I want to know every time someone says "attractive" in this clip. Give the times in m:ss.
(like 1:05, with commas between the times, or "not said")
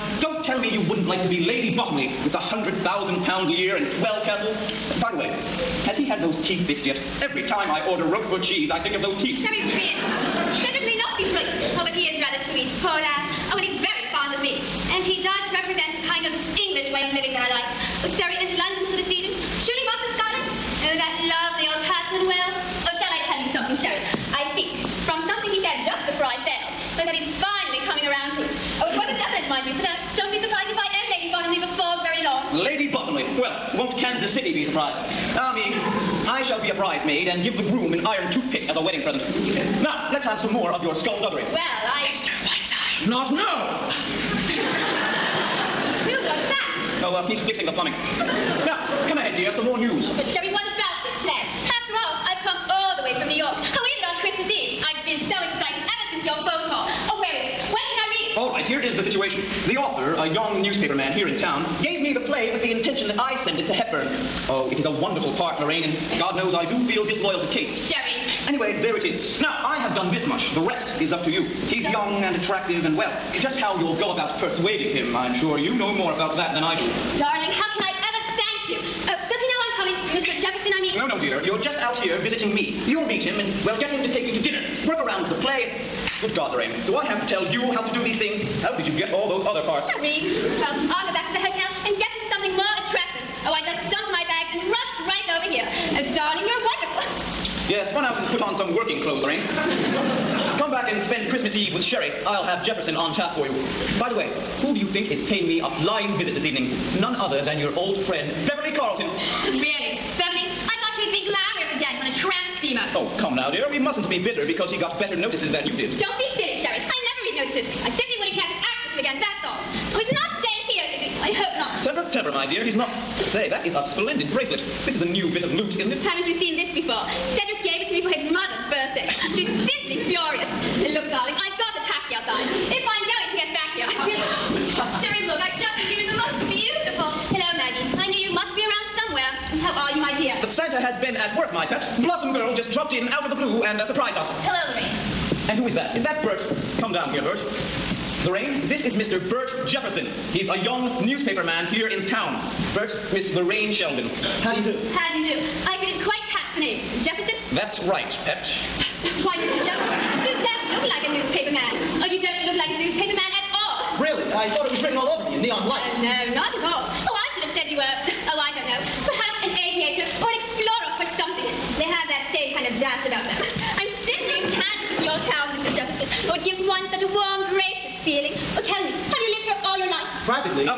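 1:12, 1:32.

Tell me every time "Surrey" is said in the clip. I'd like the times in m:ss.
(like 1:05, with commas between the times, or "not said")
0:18.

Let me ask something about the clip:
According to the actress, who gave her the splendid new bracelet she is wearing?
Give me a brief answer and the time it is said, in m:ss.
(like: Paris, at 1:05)
Cedric, at 2:07.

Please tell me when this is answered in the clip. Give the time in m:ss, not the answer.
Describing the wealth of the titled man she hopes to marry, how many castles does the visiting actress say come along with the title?
0:04.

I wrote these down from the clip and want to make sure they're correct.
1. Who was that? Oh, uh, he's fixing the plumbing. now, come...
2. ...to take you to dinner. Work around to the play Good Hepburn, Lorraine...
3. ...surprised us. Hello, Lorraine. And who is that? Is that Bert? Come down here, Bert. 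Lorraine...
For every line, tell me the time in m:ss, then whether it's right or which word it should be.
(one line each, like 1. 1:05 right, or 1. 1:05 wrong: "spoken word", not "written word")
1. 0:46 right
2. 1:24 wrong: "God", not "Hepburn"
3. 2:23 right.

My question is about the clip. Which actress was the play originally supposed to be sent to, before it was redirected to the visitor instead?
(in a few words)
Hepburn.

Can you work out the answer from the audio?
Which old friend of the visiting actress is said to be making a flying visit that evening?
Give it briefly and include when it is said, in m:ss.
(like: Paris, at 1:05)
Beverly Carlton, at 1:48.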